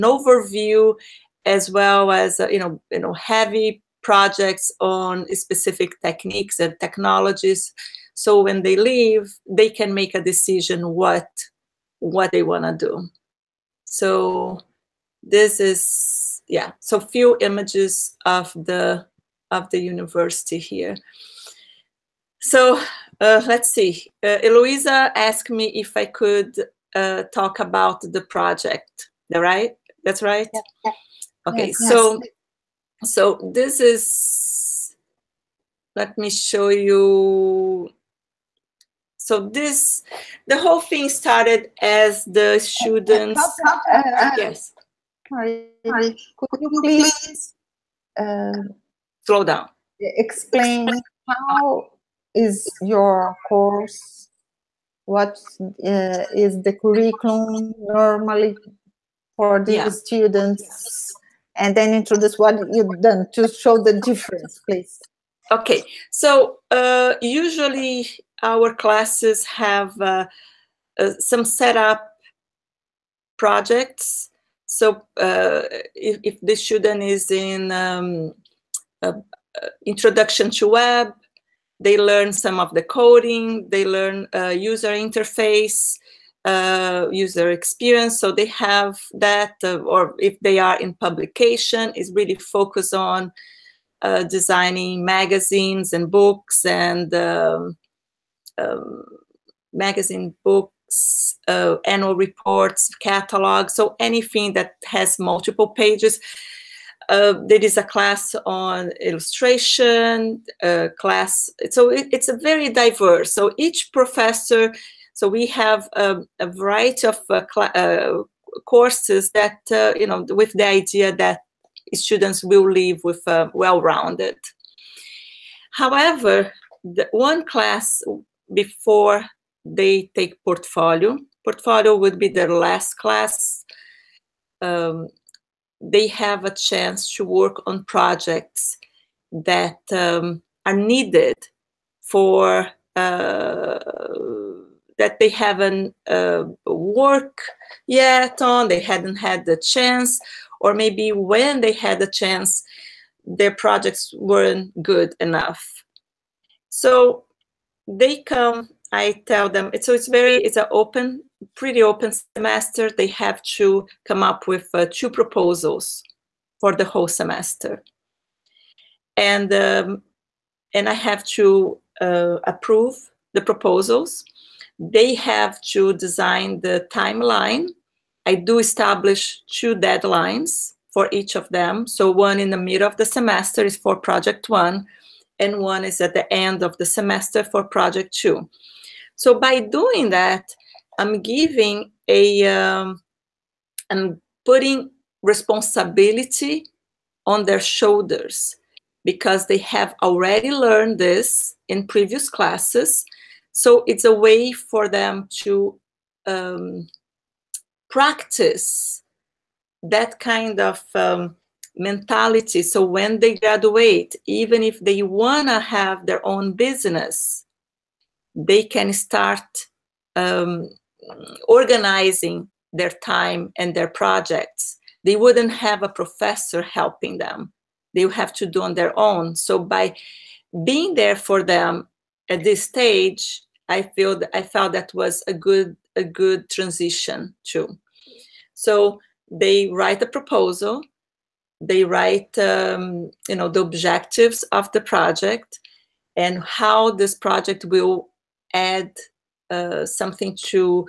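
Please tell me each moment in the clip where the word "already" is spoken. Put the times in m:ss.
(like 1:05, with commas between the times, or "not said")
3:20.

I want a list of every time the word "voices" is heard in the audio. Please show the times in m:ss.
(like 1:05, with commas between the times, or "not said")
not said.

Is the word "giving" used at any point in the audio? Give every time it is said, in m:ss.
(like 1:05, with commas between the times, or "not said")
3:11.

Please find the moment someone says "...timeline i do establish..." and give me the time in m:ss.
2:56.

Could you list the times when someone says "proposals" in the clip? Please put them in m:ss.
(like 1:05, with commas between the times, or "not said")
2:45, 2:53, 4:00.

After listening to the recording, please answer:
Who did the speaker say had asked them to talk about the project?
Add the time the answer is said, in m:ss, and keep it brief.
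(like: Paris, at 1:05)
Eloisa, at 0:24.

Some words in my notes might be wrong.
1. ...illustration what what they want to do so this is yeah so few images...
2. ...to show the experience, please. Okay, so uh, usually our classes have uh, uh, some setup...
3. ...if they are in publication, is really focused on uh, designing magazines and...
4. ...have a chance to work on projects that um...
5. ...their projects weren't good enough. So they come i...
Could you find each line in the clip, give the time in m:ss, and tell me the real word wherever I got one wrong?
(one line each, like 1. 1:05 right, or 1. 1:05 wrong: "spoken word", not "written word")
1. 0:10 wrong: "decision", not "illustration"
2. 1:03 wrong: "difference", not "experience"
3. 1:30 right
4. 2:16 right
5. 2:33 right.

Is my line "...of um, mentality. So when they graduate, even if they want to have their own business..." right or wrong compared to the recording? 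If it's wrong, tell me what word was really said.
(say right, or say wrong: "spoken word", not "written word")
right.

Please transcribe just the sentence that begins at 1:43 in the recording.
So anything that has multiple pages.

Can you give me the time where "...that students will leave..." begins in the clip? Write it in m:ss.
2:01.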